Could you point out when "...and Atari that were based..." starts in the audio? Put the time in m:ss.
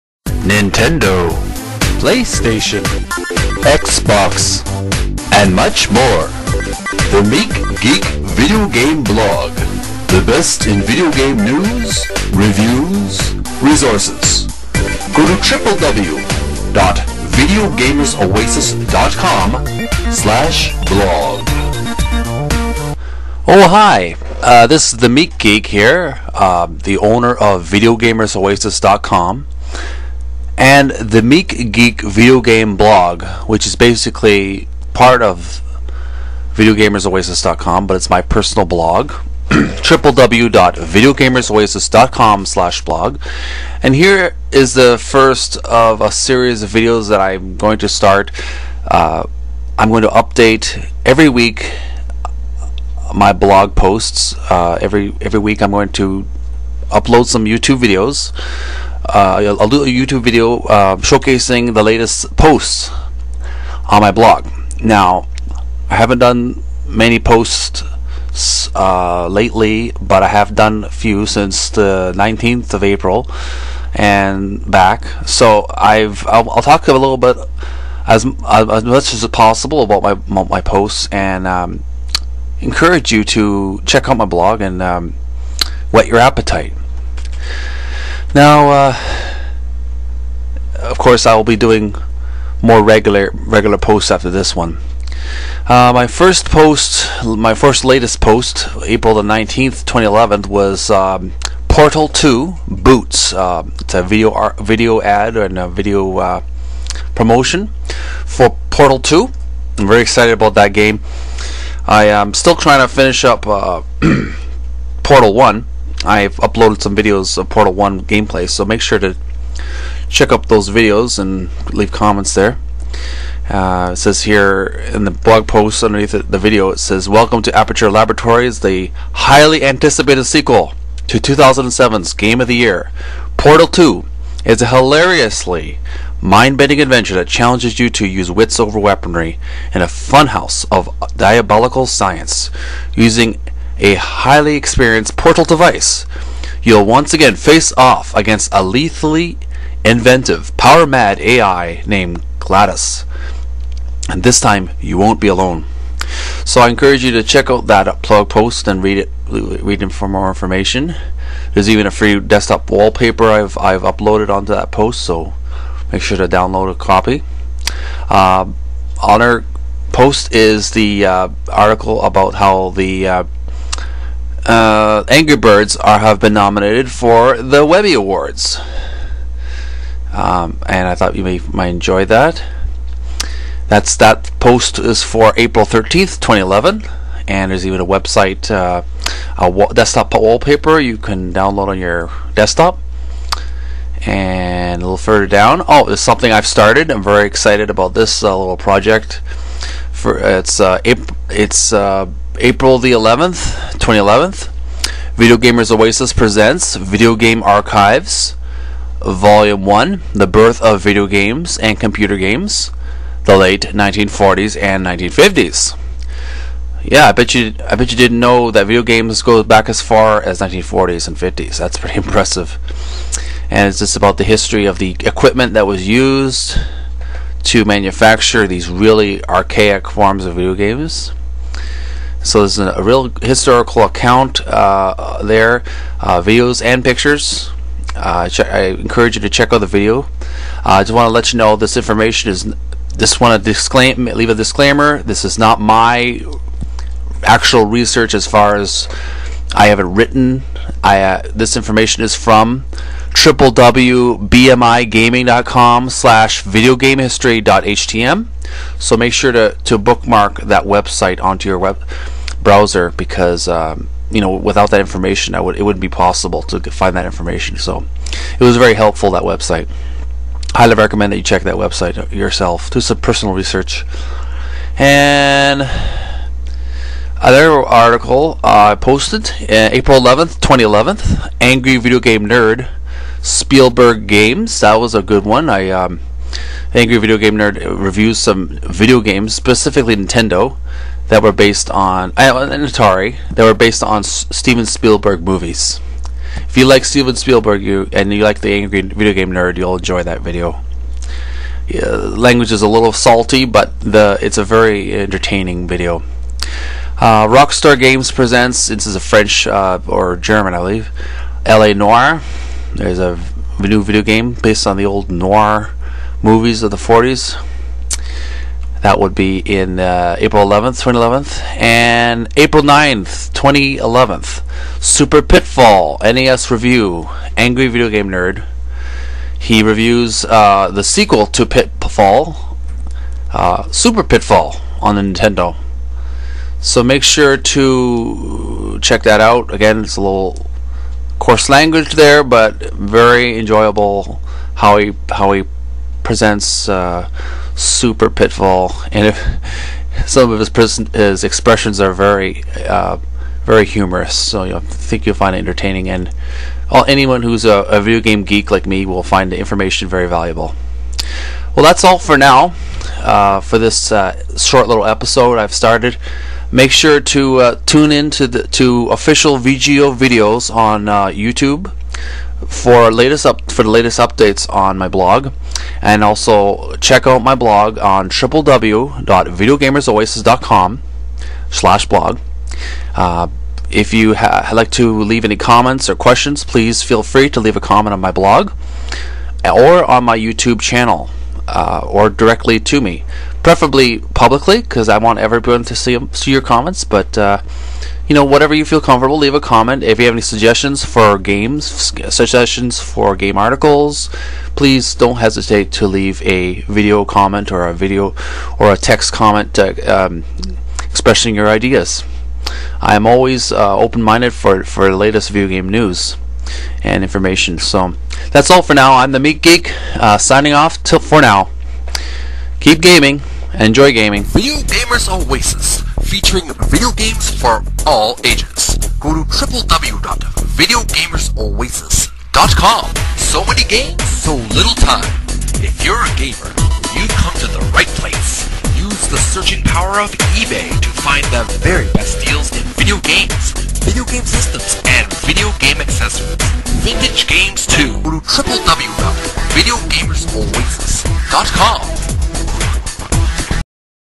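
4:52.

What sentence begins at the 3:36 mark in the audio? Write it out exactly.
Yeah, I bet you I bet you didn't know that video games go back as far as 1940s and 50s.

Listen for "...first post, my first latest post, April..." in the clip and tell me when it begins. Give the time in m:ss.
1:36.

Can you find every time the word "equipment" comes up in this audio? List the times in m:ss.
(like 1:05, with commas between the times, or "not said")
3:45.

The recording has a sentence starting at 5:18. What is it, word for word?
That would be in uh, April 11th, 2011, and April 9th, 2011.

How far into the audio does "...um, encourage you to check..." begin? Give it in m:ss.
1:21.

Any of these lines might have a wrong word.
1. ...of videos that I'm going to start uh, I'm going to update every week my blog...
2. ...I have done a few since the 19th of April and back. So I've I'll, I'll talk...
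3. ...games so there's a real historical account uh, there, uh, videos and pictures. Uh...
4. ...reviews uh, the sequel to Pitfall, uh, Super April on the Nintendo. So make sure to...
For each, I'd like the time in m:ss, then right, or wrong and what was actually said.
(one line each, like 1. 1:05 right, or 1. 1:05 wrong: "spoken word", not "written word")
1. 0:46 right
2. 1:10 right
3. 3:50 right
4. 5:29 wrong: "Pitfall", not "April".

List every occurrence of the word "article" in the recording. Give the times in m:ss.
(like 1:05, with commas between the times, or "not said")
2:51, 4:37, 6:43.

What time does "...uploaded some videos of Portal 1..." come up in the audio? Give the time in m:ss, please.
1:56.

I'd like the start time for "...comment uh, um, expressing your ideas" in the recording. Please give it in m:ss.
6:49.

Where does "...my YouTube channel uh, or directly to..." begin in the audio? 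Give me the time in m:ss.
6:30.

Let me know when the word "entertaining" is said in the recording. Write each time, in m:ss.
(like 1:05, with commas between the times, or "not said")
5:04, 5:55.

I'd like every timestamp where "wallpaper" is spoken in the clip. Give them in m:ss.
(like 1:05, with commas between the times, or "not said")
2:42, 3:10.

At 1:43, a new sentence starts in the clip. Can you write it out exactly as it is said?
Uh, it's a video art, video ad and a video uh, promotion for Portal 2.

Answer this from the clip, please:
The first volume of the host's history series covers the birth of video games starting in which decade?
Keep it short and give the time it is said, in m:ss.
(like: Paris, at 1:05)
1940s, at 3:33.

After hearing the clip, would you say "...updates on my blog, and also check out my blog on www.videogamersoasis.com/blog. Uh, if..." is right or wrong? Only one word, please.
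right.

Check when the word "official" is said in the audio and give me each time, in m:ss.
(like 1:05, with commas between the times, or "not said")
6:08.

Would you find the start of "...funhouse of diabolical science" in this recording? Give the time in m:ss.
2:19.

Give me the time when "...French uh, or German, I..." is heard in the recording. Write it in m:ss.
5:08.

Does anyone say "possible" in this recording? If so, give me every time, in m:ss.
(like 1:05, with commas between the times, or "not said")
1:19, 4:25.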